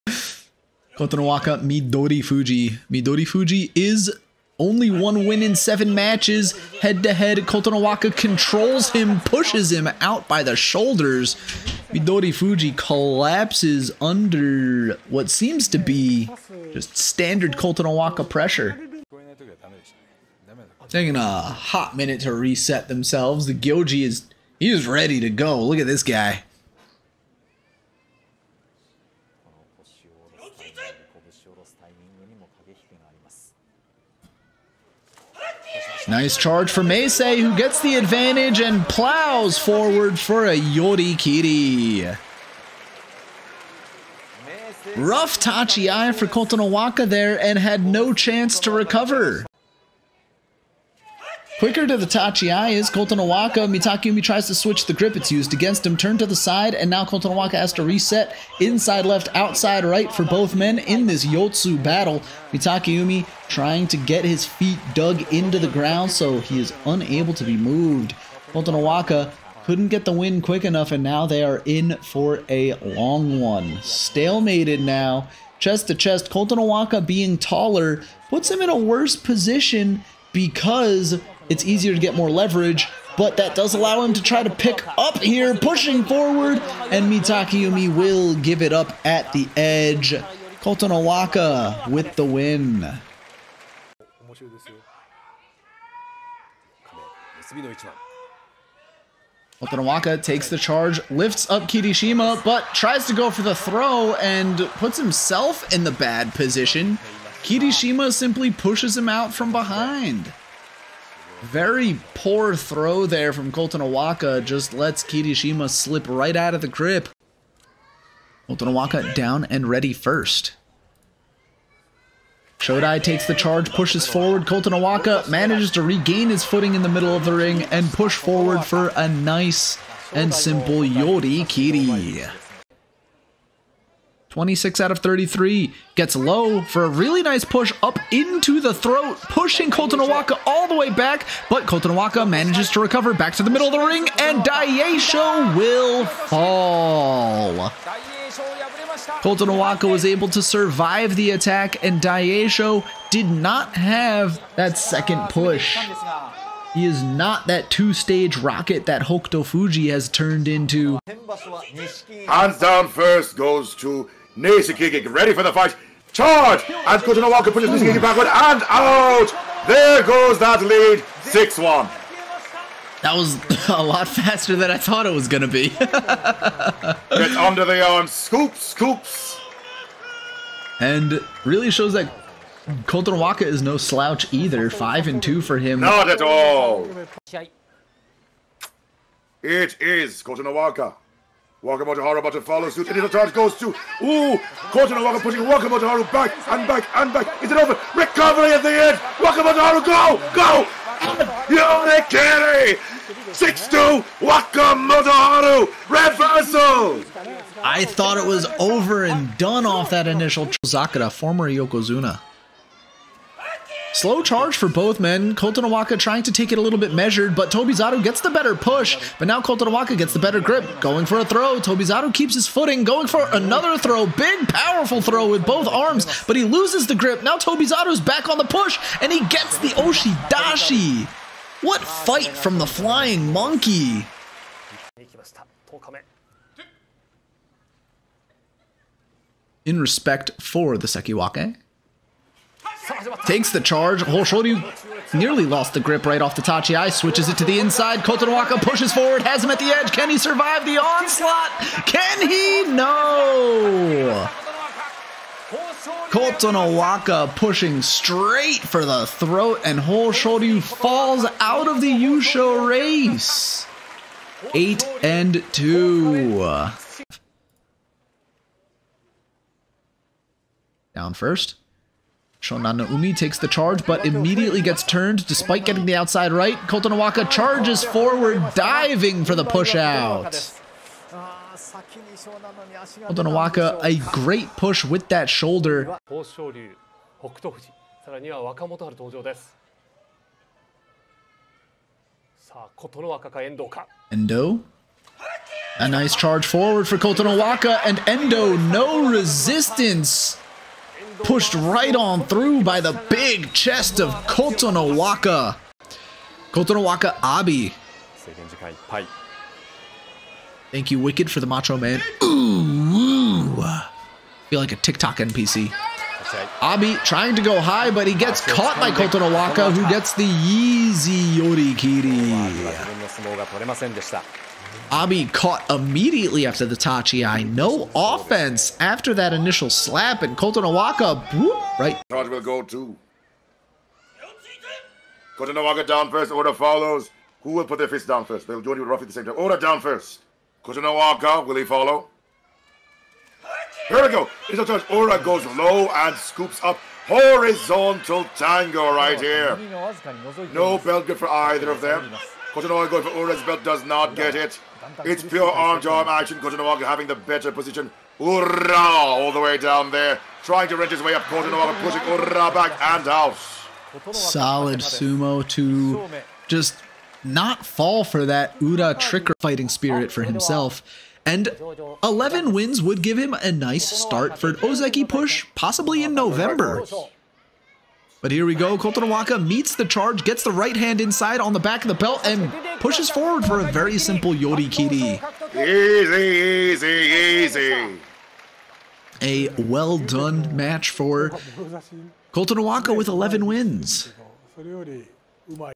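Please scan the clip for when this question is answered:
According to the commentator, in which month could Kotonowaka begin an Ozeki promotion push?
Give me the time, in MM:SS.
06:16.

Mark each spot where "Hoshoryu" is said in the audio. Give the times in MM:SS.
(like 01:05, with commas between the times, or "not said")
04:04, 04:19.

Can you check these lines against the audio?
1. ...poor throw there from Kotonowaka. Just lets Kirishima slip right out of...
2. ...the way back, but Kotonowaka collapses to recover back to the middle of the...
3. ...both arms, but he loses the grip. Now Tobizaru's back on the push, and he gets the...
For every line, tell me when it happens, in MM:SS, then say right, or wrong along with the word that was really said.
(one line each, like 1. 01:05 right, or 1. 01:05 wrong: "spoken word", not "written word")
1. 01:52 right
2. 02:20 wrong: "manages", not "collapses"
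3. 03:45 right.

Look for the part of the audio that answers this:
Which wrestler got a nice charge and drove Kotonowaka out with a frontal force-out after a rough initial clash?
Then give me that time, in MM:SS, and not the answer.
00:36.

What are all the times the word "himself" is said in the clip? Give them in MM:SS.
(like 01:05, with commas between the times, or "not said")
01:44, 06:10.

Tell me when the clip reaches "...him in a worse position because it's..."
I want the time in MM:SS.
01:18.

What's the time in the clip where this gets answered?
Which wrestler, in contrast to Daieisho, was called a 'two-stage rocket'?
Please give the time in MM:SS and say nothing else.
02:39.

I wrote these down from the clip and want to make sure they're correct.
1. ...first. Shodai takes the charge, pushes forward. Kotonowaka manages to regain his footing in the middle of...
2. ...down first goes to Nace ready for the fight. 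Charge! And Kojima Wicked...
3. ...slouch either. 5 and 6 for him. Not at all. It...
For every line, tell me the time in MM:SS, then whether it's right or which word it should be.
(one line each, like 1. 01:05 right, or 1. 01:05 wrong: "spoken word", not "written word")
1. 01:59 right
2. 02:42 wrong: "Walker", not "Wicked"
3. 03:03 wrong: "2", not "6".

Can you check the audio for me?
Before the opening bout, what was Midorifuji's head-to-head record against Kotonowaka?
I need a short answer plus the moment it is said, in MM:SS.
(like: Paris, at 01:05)
1 win in 7, at 00:04.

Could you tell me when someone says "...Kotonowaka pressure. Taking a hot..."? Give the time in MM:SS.
00:17.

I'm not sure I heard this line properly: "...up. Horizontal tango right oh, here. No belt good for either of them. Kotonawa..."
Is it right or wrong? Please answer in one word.
right.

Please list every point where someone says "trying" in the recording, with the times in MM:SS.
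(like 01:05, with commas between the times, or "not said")
01:03, 03:35, 05:17, 06:00.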